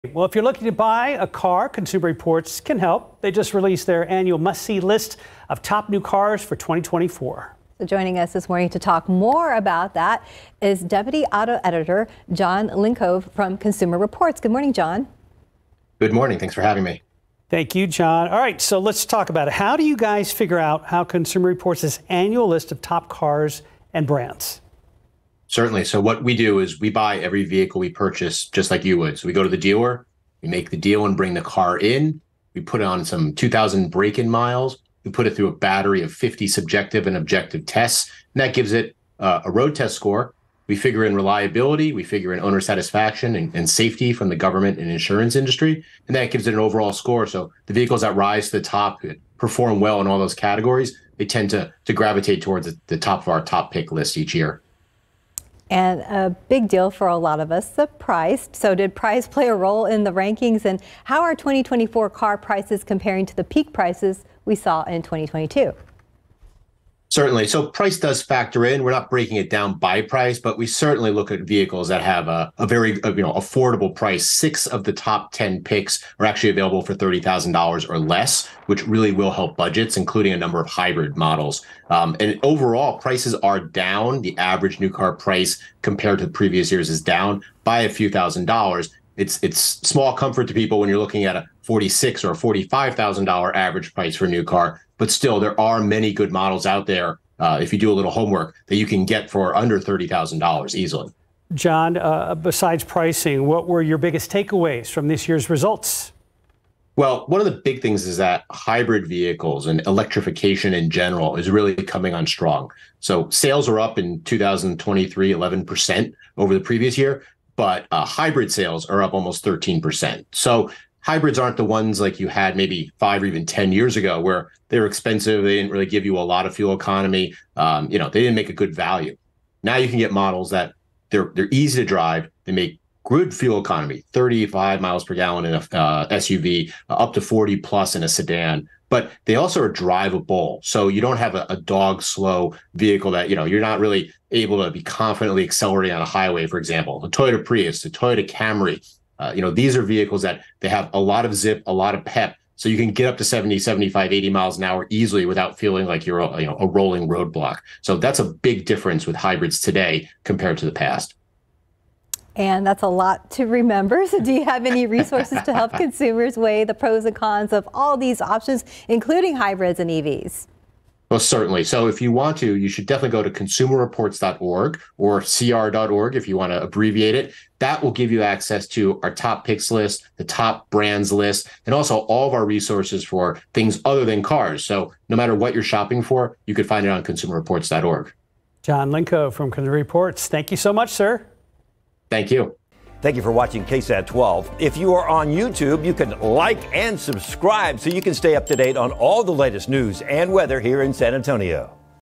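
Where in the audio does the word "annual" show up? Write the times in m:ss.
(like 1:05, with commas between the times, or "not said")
0:04, 0:22.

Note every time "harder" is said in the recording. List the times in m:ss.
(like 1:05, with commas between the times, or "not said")
not said.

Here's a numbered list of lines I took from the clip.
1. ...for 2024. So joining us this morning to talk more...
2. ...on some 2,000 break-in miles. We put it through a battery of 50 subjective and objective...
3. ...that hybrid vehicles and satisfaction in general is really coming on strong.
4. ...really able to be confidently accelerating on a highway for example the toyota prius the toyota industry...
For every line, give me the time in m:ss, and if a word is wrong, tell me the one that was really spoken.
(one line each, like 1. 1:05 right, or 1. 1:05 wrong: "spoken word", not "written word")
1. 0:06 right
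2. 0:32 right
3. 1:48 wrong: "electrification", not "satisfaction"
4. 2:23 wrong: "camry", not "industry".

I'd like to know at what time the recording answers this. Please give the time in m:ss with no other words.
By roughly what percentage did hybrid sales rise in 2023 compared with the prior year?
1:59.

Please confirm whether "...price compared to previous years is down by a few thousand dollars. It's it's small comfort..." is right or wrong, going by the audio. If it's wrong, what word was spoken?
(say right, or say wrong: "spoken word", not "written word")
right.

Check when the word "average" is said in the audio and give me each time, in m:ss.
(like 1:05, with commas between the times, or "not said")
1:24, 1:33.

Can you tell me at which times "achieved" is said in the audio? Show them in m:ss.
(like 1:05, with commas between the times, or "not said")
not said.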